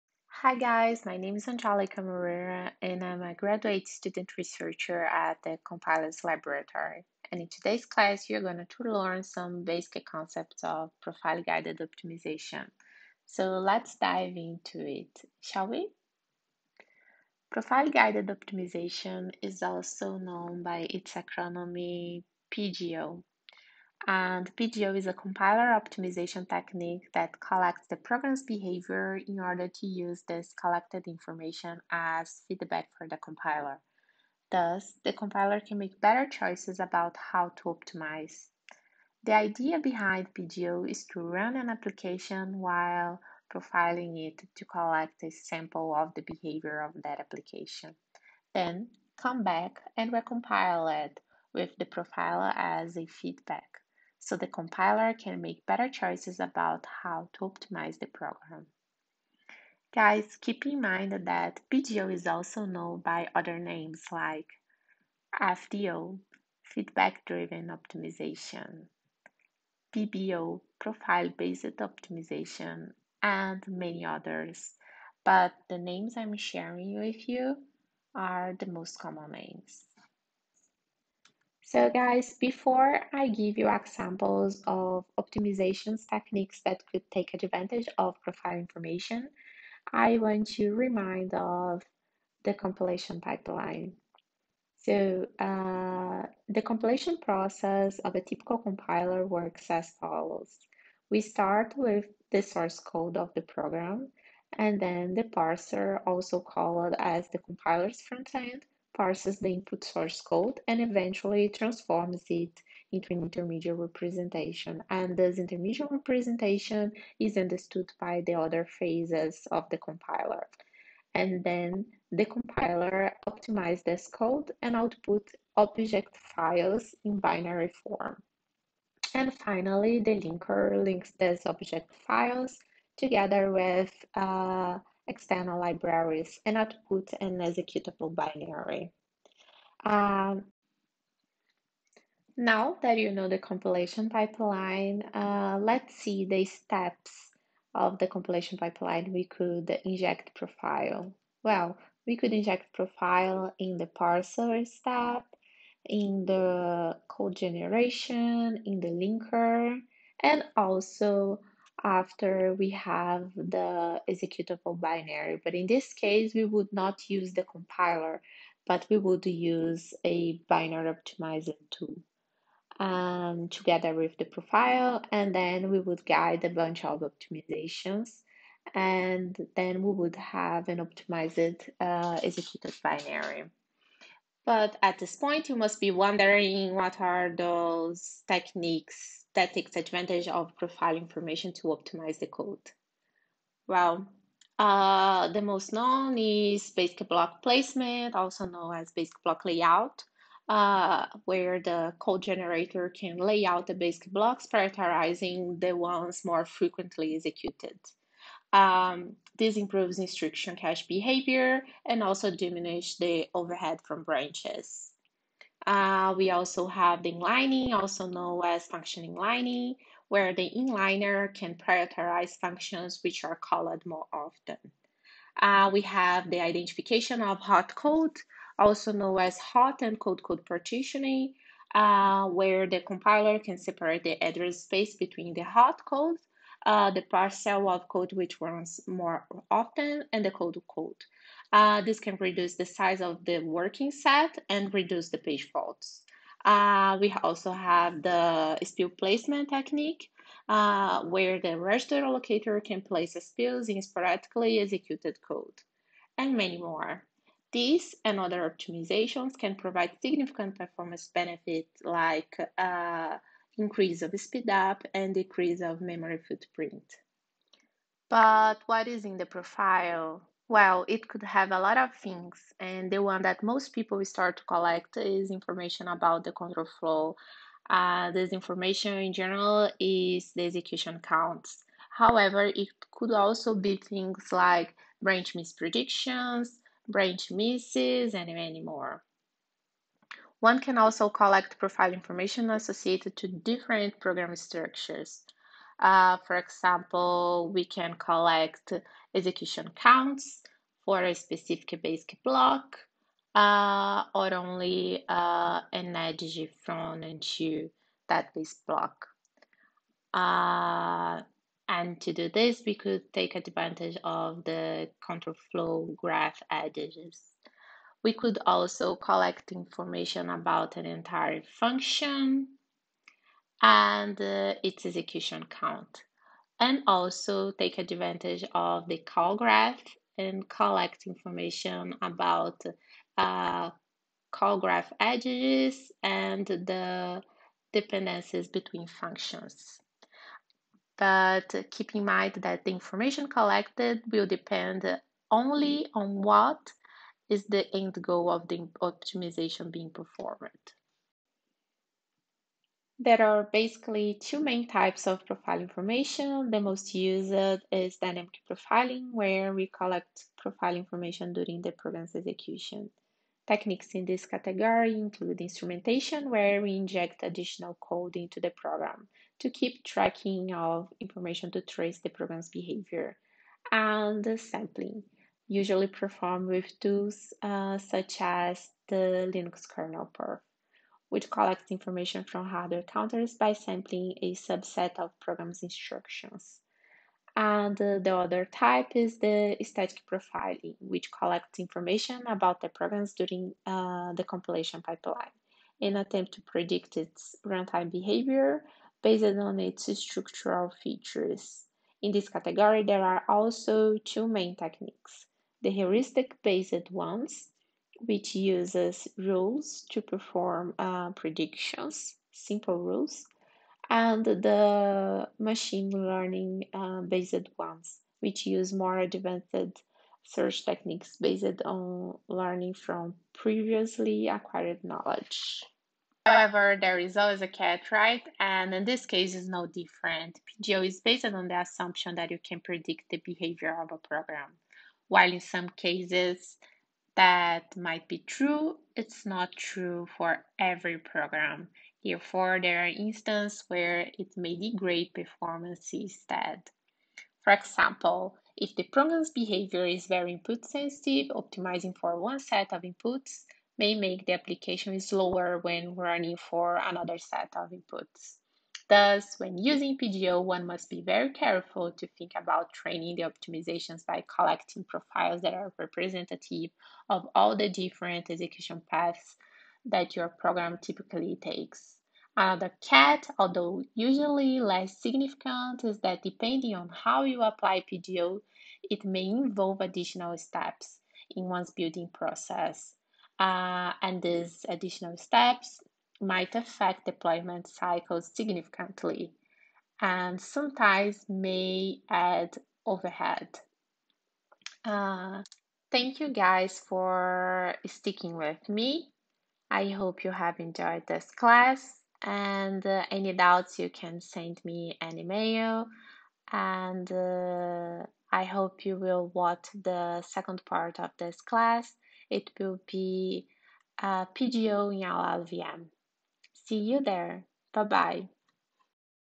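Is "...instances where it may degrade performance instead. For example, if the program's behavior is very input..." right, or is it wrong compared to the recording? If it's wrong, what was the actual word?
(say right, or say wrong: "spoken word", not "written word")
right.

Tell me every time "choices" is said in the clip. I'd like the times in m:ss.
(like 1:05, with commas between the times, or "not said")
0:36, 0:55.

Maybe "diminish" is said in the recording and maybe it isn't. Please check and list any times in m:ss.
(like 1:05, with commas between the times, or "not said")
3:32.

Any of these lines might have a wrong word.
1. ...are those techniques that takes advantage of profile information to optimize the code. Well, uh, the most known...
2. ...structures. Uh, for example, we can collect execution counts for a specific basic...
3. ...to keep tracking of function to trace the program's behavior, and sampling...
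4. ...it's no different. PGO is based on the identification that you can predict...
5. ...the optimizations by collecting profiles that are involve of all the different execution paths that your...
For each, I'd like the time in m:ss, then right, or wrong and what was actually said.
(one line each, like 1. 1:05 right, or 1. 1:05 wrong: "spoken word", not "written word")
1. 3:06 right
2. 4:54 right
3. 6:09 wrong: "information", not "function"
4. 7:09 wrong: "assumption", not "identification"
5. 7:43 wrong: "representative", not "involve".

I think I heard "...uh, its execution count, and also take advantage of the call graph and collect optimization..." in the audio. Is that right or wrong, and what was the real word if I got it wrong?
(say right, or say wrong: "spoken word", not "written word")
wrong: "information", not "optimization".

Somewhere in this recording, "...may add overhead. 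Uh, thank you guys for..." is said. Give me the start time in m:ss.
8:11.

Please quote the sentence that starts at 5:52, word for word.
There are basically two main types of profile information.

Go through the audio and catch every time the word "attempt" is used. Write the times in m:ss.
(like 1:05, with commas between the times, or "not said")
6:35.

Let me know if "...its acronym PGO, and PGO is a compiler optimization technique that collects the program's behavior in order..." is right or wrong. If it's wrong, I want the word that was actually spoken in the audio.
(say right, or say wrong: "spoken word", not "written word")
right.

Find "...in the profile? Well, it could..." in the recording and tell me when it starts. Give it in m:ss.
4:29.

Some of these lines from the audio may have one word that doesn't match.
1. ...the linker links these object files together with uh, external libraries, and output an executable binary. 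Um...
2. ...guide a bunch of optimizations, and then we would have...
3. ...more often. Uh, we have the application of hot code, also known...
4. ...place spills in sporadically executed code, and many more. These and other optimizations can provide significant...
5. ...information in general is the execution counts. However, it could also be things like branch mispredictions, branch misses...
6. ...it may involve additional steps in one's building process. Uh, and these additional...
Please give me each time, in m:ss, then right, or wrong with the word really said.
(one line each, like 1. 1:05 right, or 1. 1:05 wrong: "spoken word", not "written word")
1. 2:09 right
2. 2:56 right
3. 3:43 wrong: "identification", not "application"
4. 4:12 right
5. 4:38 right
6. 7:58 right.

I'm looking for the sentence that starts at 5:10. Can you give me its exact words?
Uh, and to do this, we could take advantage of the control flow graph edges.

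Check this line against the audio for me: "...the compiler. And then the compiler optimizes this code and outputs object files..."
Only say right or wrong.
right.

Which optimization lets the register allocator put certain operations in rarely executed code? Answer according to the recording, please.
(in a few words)
spill placement.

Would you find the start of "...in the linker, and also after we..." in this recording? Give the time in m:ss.
2:38.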